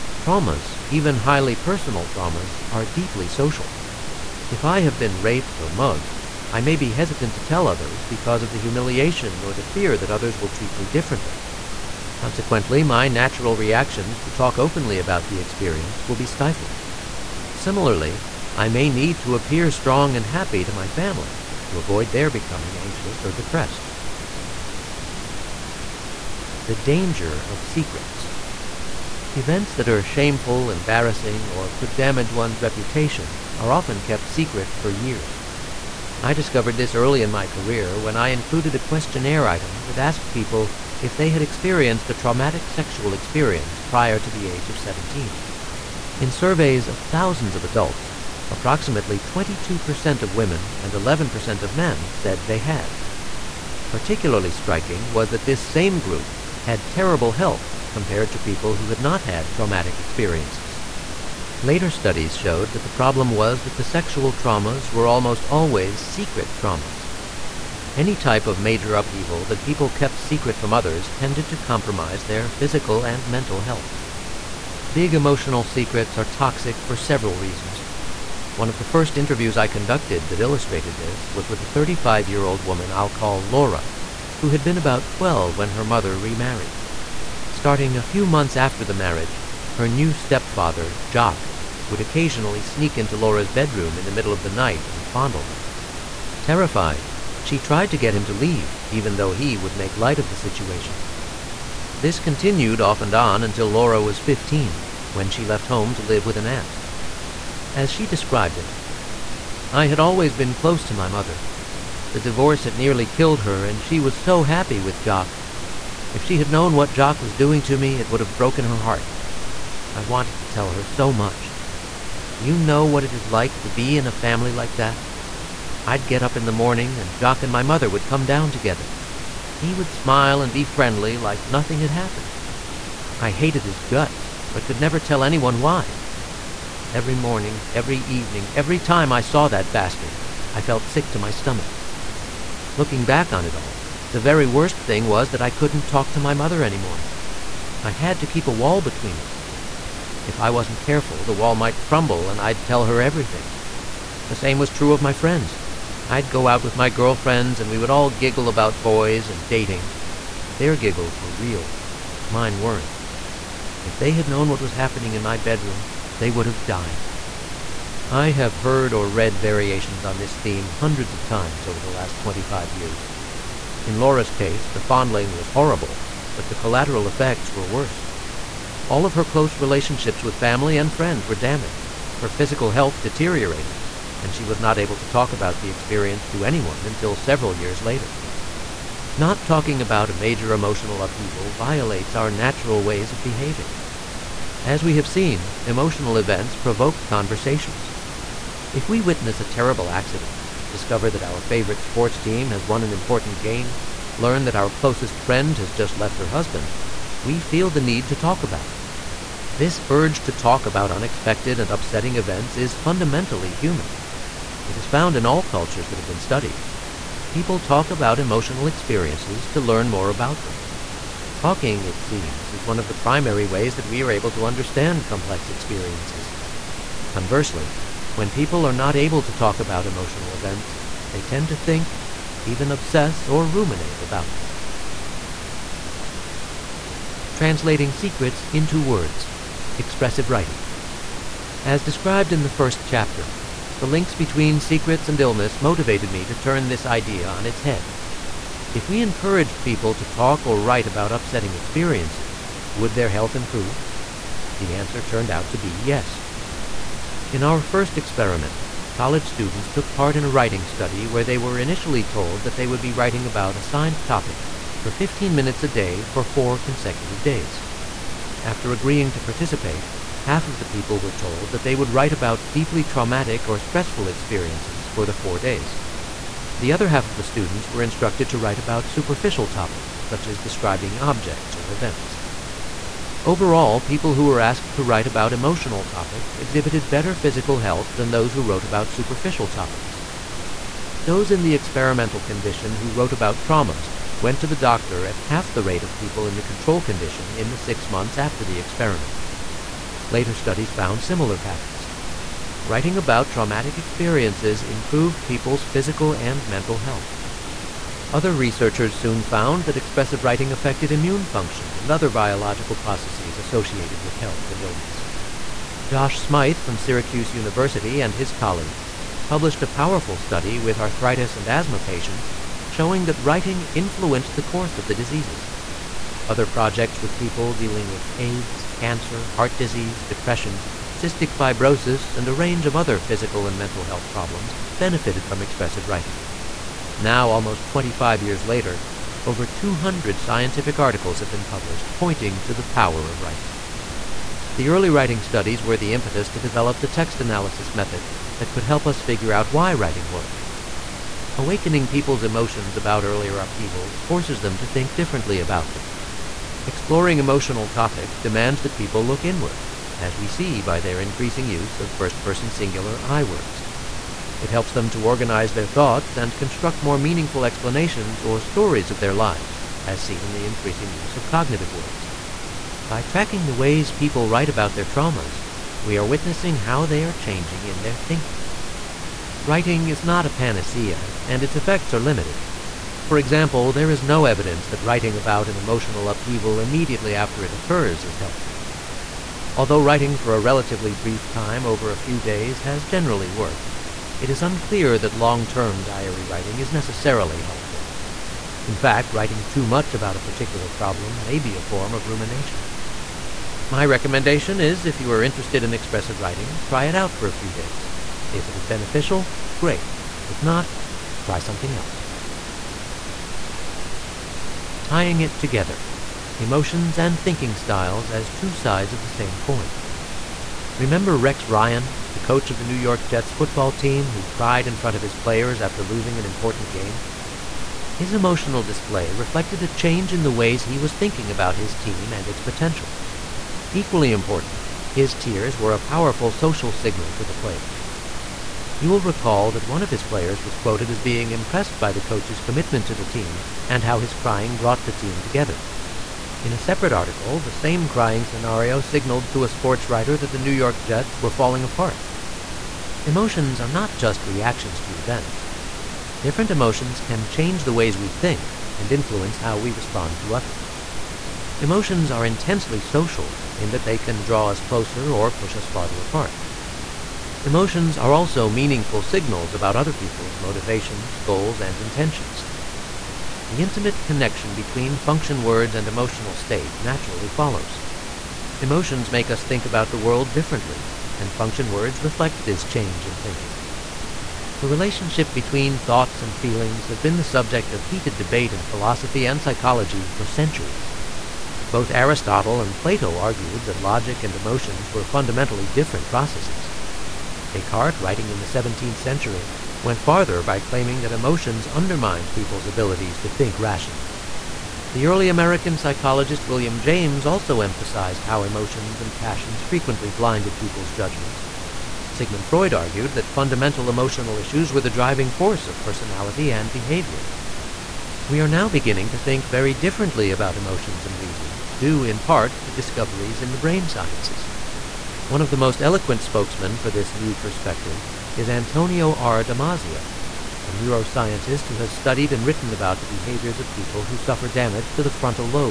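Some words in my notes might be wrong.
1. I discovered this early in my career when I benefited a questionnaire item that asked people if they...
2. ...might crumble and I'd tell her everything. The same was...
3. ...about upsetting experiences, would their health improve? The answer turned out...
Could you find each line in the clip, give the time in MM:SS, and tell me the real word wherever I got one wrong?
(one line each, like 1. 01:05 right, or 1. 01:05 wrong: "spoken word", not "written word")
1. 00:36 wrong: "included", not "benefited"
2. 02:31 right
3. 04:10 right.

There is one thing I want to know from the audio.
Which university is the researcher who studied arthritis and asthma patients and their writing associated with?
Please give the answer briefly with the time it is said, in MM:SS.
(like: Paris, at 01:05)
Syracuse University, at 05:16.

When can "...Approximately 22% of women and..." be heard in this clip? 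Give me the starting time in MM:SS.
00:48.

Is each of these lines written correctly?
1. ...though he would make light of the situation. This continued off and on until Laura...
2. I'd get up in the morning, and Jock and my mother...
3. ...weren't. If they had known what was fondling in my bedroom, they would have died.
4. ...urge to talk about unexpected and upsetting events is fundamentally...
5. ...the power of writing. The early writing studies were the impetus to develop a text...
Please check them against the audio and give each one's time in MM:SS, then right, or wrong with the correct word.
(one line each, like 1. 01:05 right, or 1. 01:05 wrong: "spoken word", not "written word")
1. 01:39 right
2. 02:05 right
3. 02:42 wrong: "happening", not "fondling"
4. 03:29 right
5. 05:42 right.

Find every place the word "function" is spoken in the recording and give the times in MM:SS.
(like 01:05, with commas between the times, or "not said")
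05:11, 07:54, 08:01.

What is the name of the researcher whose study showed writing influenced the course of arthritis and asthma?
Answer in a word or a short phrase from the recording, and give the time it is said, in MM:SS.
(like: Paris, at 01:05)
Josh Smyth, at 05:15.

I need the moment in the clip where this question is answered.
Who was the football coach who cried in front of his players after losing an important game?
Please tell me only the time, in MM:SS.
07:01.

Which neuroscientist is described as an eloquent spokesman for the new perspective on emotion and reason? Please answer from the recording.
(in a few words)
Antonio R. Damasio.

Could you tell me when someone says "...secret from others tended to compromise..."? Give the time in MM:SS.
01:10.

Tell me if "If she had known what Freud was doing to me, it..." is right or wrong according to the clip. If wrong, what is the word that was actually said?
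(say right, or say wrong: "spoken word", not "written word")
wrong: "Jock", not "Freud".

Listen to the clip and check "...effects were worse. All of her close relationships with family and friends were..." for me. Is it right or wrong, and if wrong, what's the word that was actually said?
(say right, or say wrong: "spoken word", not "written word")
right.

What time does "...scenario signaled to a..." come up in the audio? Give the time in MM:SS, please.
07:28.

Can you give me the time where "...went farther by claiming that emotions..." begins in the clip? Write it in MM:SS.
08:19.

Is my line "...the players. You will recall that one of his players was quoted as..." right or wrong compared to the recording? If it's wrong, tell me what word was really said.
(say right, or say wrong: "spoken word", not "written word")
right.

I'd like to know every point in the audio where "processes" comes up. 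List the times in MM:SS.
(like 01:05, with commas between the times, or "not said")
05:12, 08:16.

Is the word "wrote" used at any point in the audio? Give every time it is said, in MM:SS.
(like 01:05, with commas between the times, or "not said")
04:48, 04:52.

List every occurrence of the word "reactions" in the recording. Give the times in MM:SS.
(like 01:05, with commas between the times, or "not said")
00:13, 07:34.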